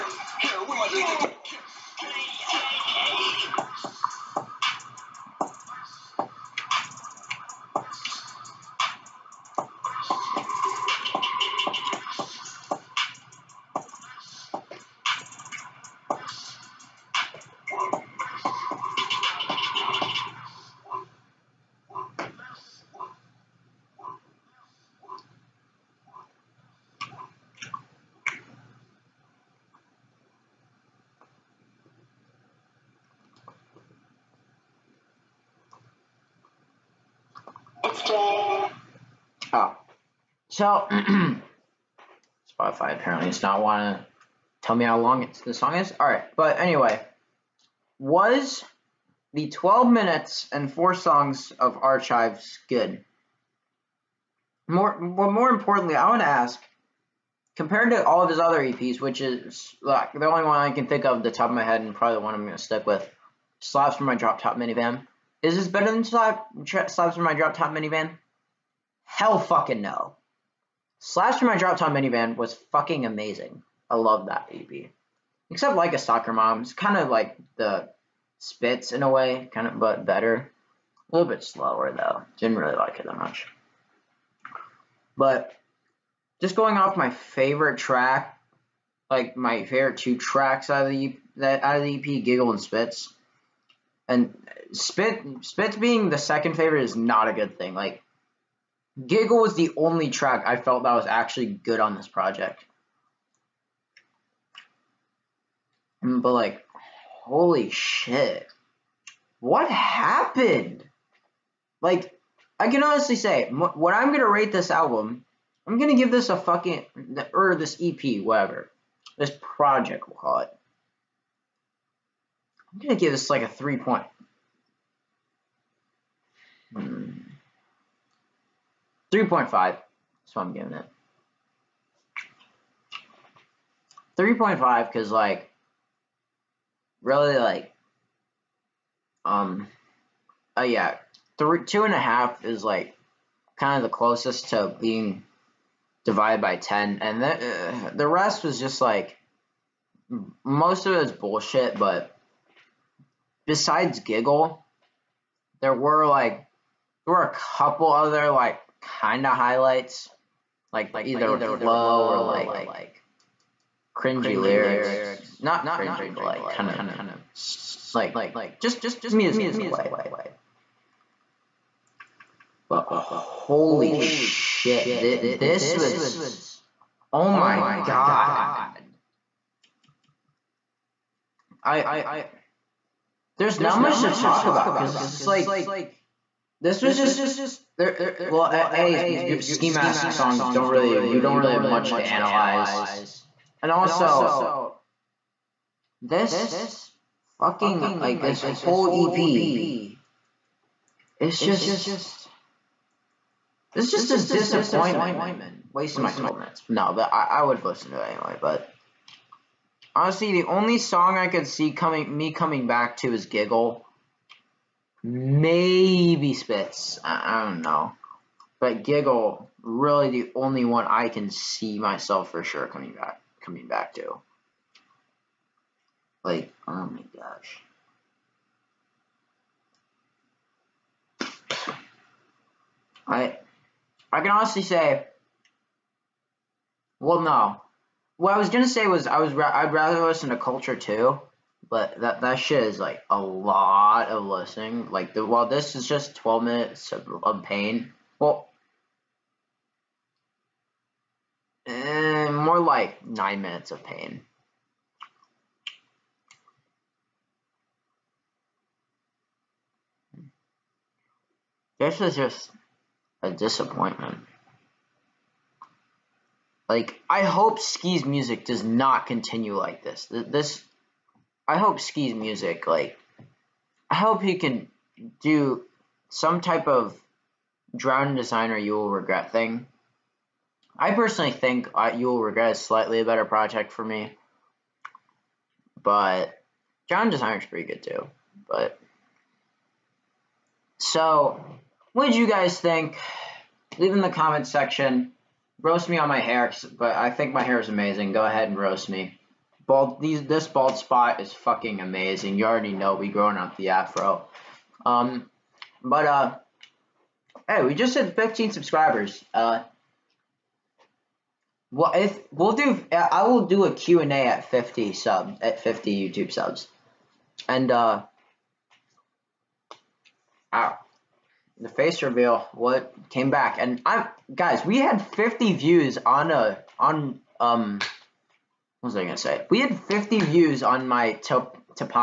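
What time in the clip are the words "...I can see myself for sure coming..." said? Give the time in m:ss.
3:40.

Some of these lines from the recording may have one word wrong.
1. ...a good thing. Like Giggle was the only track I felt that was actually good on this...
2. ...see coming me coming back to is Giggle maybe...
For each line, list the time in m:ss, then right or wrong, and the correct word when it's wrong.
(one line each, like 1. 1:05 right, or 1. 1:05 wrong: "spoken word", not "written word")
1. 1:37 right
2. 3:31 right.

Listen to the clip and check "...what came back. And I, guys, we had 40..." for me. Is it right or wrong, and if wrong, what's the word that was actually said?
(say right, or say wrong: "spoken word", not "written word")
wrong: "50", not "40".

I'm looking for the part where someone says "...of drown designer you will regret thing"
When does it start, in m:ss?
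4:36.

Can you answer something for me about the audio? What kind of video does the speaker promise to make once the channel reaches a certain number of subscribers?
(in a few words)
Q&A.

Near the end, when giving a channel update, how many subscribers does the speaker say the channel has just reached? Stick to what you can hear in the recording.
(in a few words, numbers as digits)
15.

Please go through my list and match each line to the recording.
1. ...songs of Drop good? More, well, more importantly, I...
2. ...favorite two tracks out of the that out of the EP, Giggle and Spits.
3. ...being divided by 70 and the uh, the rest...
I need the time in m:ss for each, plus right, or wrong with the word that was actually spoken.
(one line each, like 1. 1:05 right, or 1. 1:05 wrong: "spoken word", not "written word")
1. 0:50 wrong: "Archives", not "Drop"
2. 1:29 right
3. 2:24 wrong: "10", not "70".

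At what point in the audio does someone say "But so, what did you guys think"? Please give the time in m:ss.
4:48.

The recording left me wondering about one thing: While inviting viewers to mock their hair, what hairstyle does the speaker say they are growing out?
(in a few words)
afro.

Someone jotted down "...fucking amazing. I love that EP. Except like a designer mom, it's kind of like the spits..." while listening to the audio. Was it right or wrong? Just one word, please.
wrong.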